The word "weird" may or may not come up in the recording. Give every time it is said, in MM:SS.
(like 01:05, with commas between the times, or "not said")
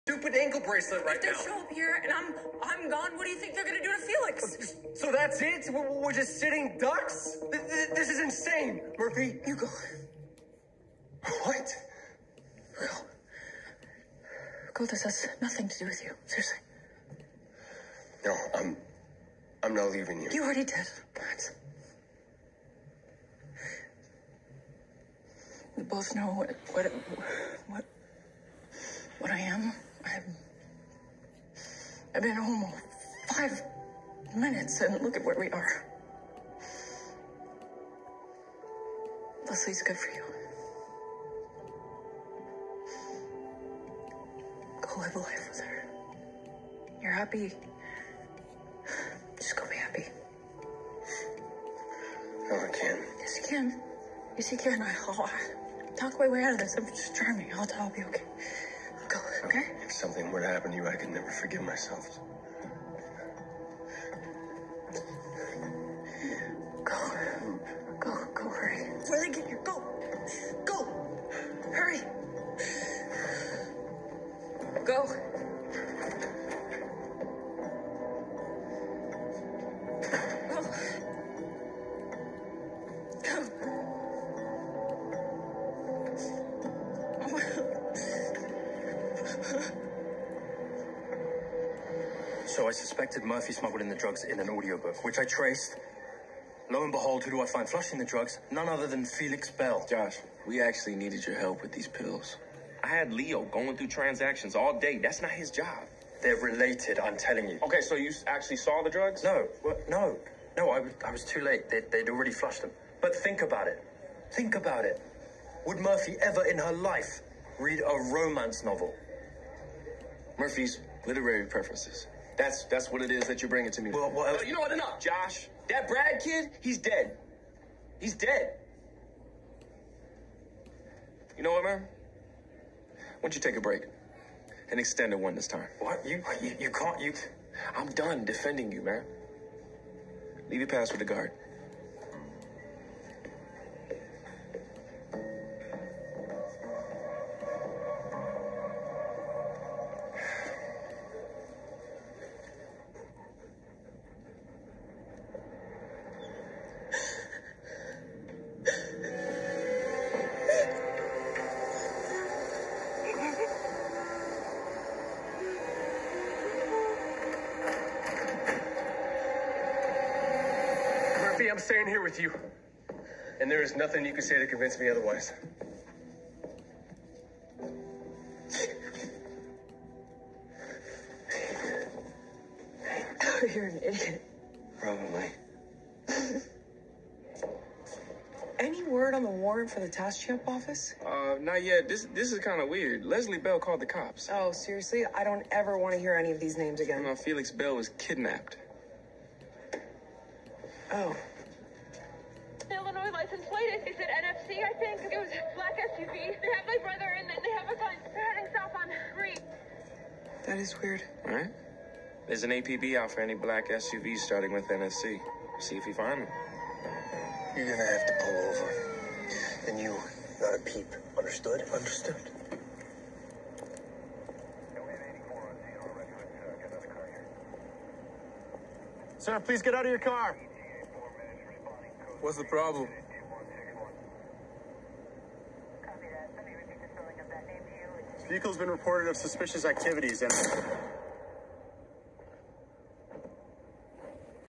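03:12, 03:30.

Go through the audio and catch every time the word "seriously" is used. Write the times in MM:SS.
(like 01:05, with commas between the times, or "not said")
00:16, 03:14.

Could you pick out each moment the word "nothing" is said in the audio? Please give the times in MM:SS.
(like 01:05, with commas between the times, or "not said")
00:15, 02:53.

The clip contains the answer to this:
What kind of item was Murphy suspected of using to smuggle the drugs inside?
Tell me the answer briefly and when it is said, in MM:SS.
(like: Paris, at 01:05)
audiobook, at 01:34.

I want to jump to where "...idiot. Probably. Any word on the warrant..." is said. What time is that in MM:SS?
03:03.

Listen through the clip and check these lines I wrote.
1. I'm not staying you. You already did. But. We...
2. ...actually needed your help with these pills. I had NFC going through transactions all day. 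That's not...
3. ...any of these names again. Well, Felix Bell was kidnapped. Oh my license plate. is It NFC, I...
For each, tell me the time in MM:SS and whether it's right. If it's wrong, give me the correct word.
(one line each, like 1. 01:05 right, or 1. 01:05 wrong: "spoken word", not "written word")
1. 00:19 wrong: "leaving", not "staying"
2. 01:40 wrong: "Leo", not "NFC"
3. 03:16 right.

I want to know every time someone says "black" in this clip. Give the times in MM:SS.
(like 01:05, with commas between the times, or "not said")
03:25, 03:33.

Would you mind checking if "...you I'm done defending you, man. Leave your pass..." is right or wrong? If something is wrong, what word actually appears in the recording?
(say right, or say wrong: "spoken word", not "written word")
right.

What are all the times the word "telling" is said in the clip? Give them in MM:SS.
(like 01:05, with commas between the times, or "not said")
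01:47.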